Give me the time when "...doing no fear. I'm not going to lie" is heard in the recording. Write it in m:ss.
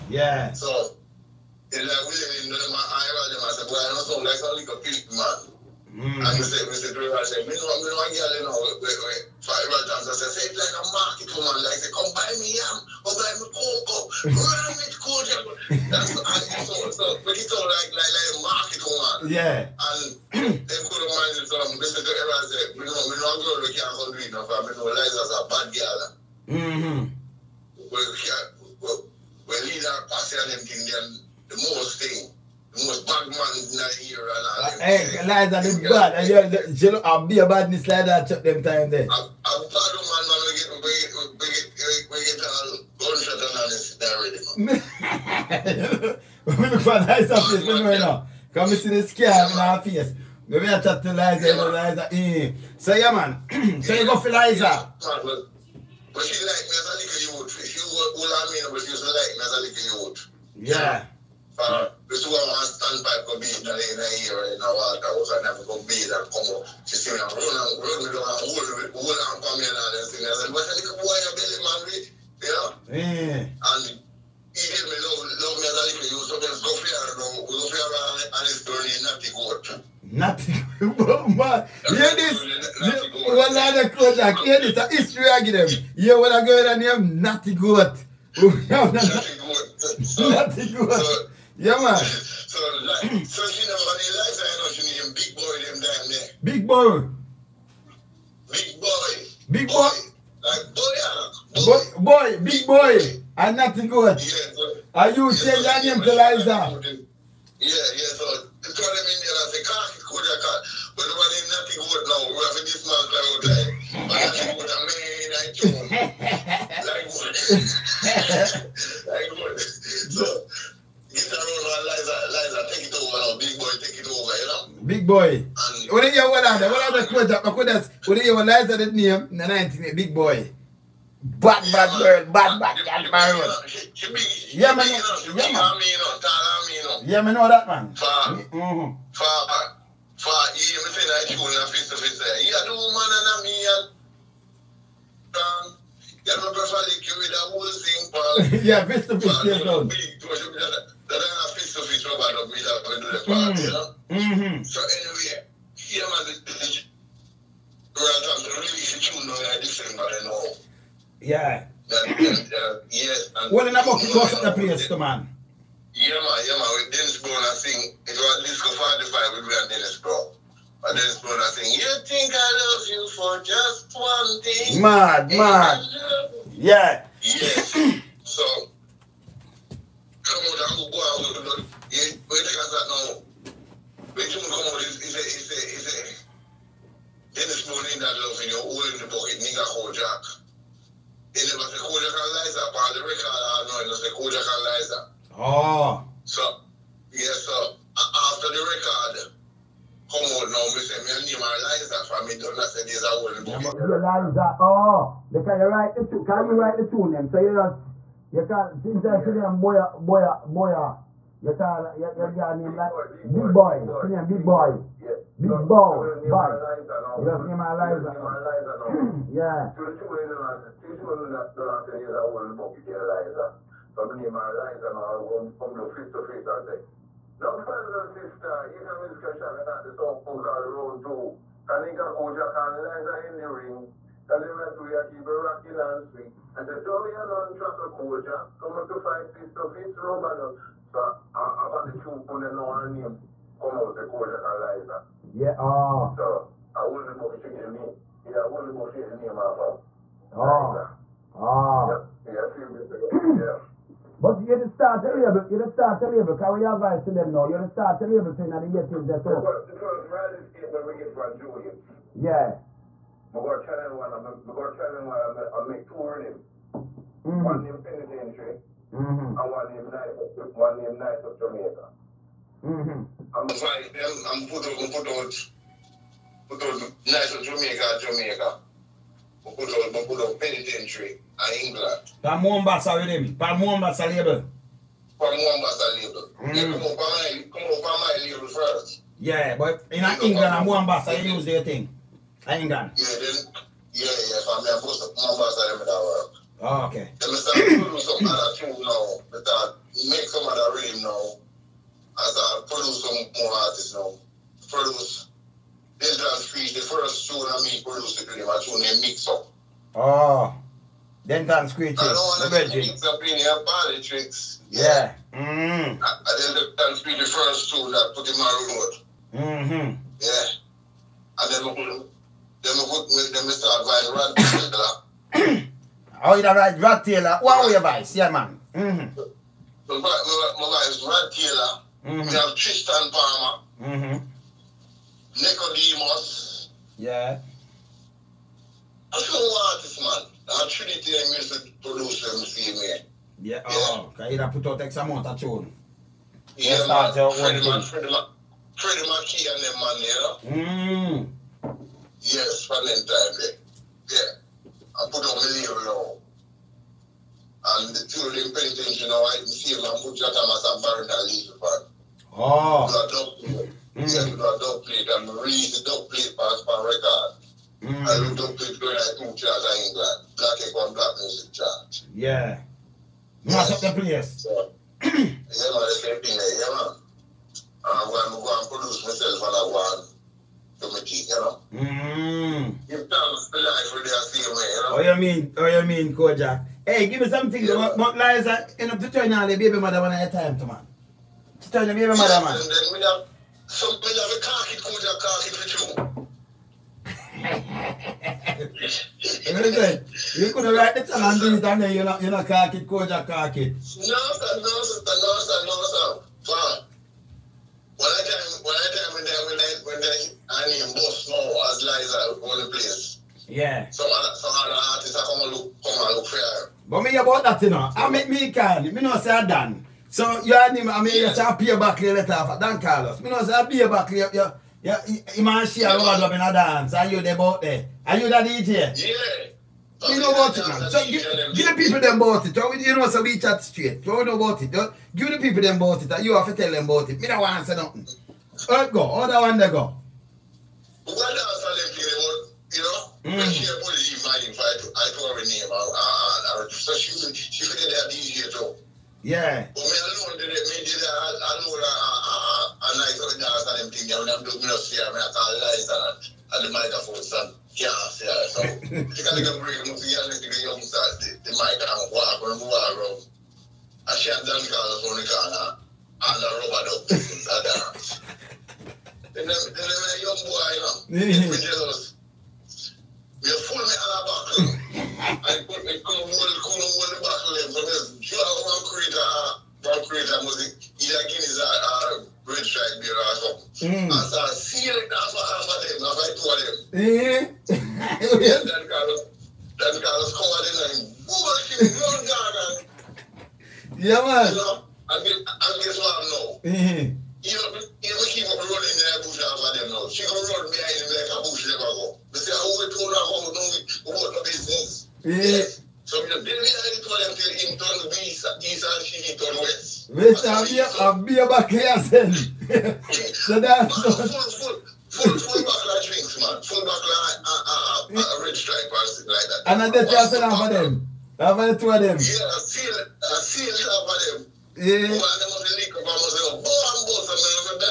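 7:34.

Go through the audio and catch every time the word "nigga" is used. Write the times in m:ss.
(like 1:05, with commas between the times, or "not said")
3:09.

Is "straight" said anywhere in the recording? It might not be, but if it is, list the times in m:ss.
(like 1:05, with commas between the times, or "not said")
7:13.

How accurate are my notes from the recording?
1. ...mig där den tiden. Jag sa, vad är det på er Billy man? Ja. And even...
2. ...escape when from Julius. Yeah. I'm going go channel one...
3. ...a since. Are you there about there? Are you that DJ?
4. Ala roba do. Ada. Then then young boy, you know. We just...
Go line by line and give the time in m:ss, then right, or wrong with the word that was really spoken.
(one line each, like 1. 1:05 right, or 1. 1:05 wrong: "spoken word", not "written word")
1. 1:09 right
2. 4:20 right
3. 7:06 wrong: "dance", not "since"
4. 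7:46 right.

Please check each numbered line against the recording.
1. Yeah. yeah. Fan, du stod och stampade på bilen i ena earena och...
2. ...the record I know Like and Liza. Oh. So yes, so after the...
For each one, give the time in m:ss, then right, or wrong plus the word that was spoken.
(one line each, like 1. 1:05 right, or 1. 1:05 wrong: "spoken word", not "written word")
1. 1:00 right
2. 3:12 wrong: "Kojak", not "Like".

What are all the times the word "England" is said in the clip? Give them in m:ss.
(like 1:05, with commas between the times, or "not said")
4:41, 4:50, 6:09.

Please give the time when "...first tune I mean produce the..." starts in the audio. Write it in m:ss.
5:06.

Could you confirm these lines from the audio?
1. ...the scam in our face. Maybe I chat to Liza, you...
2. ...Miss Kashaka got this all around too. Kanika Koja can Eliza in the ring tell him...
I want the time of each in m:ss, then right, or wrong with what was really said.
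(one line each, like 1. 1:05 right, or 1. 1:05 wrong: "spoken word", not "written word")
1. 0:48 right
2. 3:48 right.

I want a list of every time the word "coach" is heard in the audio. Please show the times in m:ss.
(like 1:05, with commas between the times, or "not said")
3:57, 4:04.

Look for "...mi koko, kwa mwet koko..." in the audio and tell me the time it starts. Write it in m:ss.
0:13.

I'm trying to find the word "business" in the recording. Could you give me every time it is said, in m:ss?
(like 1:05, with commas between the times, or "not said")
8:24.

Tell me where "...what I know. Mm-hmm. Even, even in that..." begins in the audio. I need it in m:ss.
8:15.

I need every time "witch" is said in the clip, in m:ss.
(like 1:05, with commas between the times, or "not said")
not said.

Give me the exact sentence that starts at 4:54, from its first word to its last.
So I mean, most of my boss are in that Oh, okay.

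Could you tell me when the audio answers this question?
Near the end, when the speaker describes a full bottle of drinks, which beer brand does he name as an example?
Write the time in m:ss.
8:38.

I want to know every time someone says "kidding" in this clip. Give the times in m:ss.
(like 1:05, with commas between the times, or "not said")
not said.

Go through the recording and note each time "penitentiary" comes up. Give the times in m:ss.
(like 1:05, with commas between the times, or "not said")
4:27, 4:40, 5:58.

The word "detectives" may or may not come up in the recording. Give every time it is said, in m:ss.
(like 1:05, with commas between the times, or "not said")
not said.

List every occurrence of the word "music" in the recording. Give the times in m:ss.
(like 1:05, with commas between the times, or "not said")
5:41, 6:11, 8:00.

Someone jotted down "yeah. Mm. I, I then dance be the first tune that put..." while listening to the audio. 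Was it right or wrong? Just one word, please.
right.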